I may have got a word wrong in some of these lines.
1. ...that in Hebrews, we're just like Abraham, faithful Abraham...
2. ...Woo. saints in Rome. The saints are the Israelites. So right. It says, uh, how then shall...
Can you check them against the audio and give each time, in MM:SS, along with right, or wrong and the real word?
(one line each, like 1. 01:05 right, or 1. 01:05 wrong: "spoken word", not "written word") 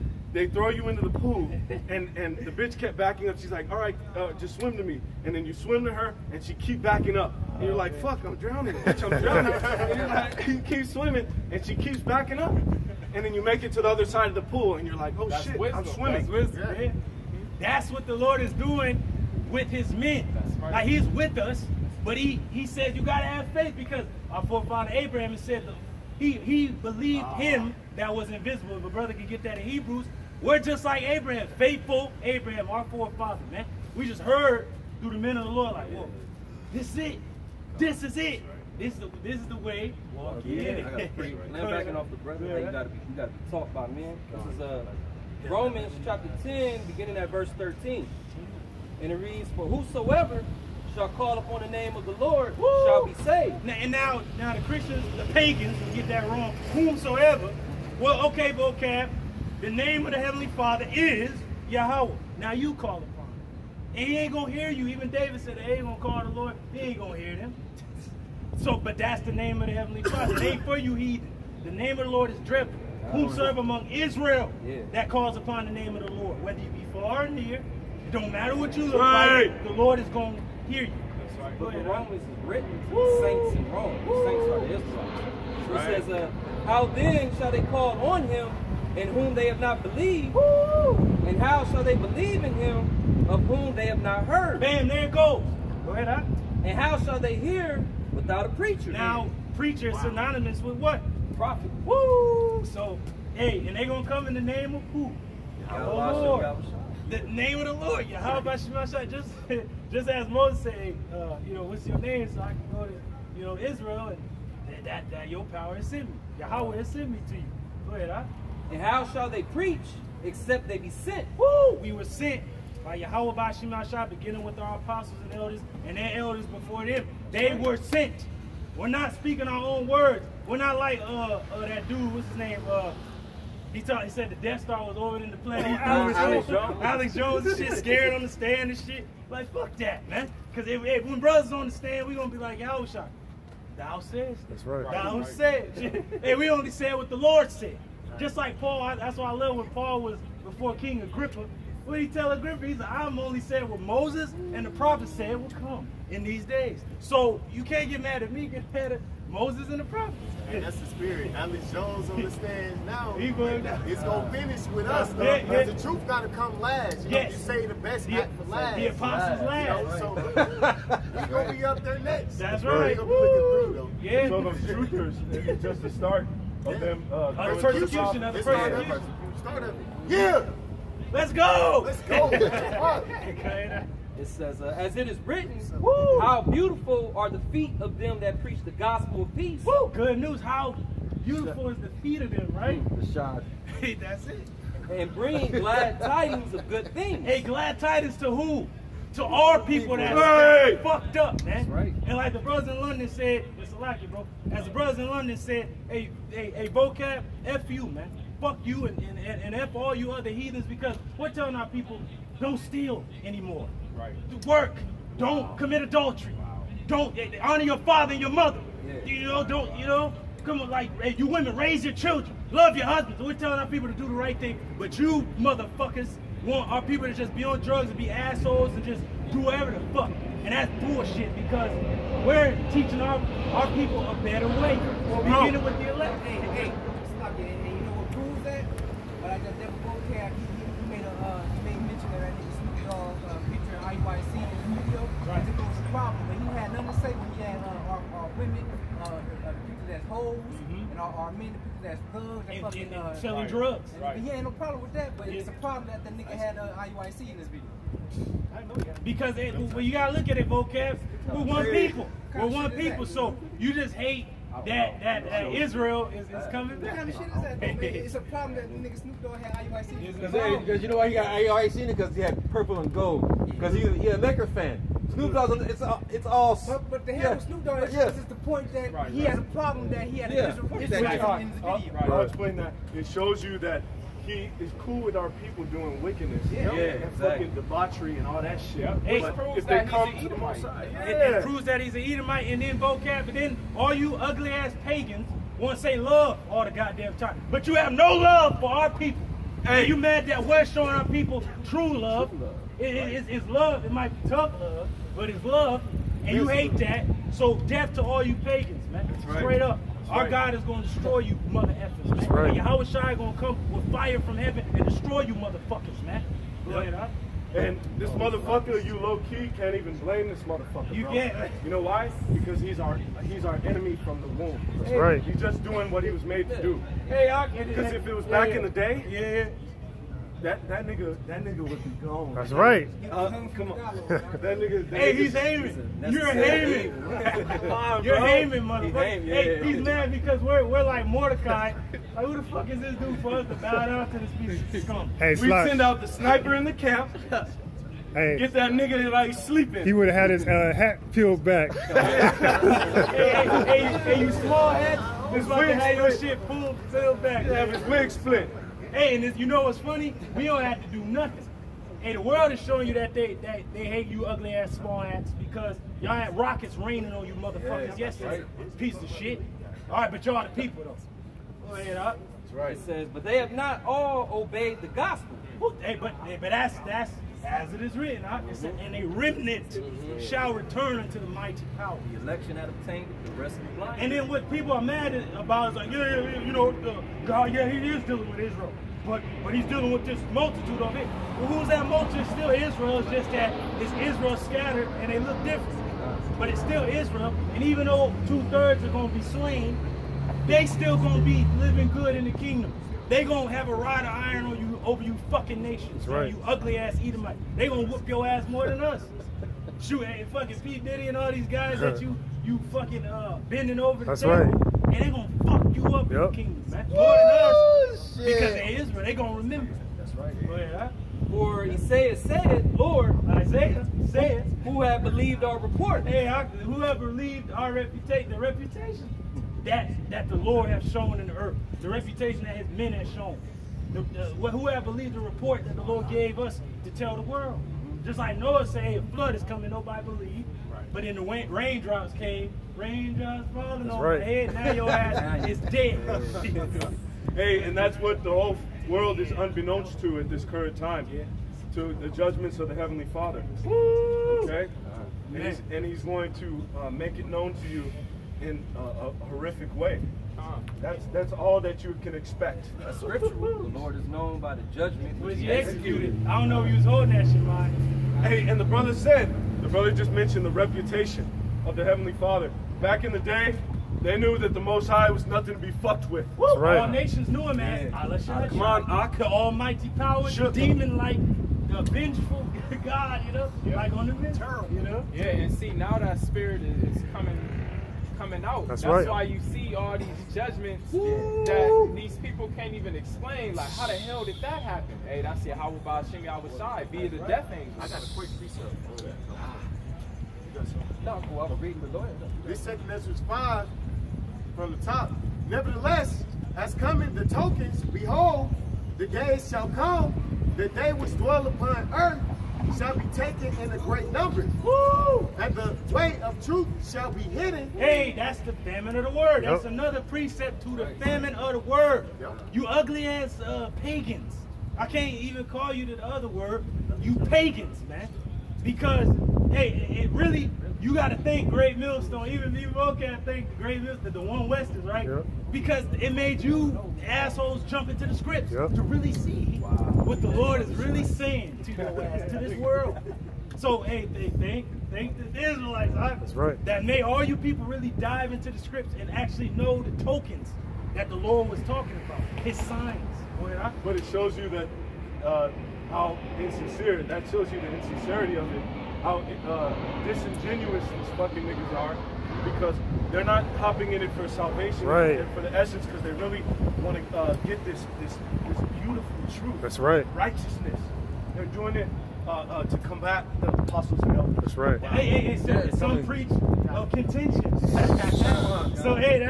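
1. 00:29 right
2. 01:22 right.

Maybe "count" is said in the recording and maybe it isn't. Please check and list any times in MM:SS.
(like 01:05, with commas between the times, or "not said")
not said.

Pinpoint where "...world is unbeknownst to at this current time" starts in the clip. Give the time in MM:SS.
07:28.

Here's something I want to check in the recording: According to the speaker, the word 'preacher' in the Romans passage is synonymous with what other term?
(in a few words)
Prophet.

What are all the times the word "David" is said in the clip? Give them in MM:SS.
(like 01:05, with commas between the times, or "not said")
01:05.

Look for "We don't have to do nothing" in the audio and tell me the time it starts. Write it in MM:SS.
06:00.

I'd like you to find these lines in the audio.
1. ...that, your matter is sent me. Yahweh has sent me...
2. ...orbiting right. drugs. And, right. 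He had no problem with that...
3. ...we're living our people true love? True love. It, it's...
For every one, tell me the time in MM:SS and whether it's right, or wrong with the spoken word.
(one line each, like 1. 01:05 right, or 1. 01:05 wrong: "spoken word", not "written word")
1. 01:55 wrong: "power", not "matter"
2. 04:13 wrong: "selling", not "orbiting"
3. 05:00 wrong: "showing", not "living".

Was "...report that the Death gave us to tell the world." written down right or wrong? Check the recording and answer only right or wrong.
wrong.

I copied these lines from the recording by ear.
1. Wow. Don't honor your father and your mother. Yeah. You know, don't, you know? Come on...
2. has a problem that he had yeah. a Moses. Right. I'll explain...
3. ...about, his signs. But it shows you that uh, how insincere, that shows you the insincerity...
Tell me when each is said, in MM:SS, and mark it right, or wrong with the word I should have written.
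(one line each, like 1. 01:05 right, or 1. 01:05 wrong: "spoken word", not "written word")
1. 03:36 right
2. 04:39 wrong: "Israel", not "Moses"
3. 09:12 right.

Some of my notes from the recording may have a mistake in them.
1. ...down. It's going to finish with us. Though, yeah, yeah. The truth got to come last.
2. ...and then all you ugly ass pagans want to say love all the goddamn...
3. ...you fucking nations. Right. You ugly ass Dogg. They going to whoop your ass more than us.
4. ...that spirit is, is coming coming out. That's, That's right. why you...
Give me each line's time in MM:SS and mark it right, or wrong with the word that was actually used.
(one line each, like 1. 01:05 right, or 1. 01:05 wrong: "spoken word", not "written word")
1. 02:43 right
2. 04:53 right
3. 06:45 wrong: "Edomite", not "Dogg"
4. 08:05 right.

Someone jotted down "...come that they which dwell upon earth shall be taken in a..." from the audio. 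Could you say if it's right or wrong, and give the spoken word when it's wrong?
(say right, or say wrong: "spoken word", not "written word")
right.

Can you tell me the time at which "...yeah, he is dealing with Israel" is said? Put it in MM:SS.
06:27.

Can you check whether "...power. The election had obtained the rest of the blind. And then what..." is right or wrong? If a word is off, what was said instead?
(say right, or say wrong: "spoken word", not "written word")
right.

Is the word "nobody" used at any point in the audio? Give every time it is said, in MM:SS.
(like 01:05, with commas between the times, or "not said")
07:19.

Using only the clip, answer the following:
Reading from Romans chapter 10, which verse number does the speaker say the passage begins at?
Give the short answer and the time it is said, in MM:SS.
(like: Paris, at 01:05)
13, at 00:47.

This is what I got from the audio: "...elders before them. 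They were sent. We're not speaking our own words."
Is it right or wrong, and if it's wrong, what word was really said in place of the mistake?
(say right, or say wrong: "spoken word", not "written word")
right.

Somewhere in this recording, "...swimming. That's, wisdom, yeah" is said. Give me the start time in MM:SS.
00:15.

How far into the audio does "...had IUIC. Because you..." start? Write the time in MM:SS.
04:29.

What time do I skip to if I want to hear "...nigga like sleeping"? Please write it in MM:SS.
05:48.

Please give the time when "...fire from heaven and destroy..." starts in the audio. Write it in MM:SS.
05:13.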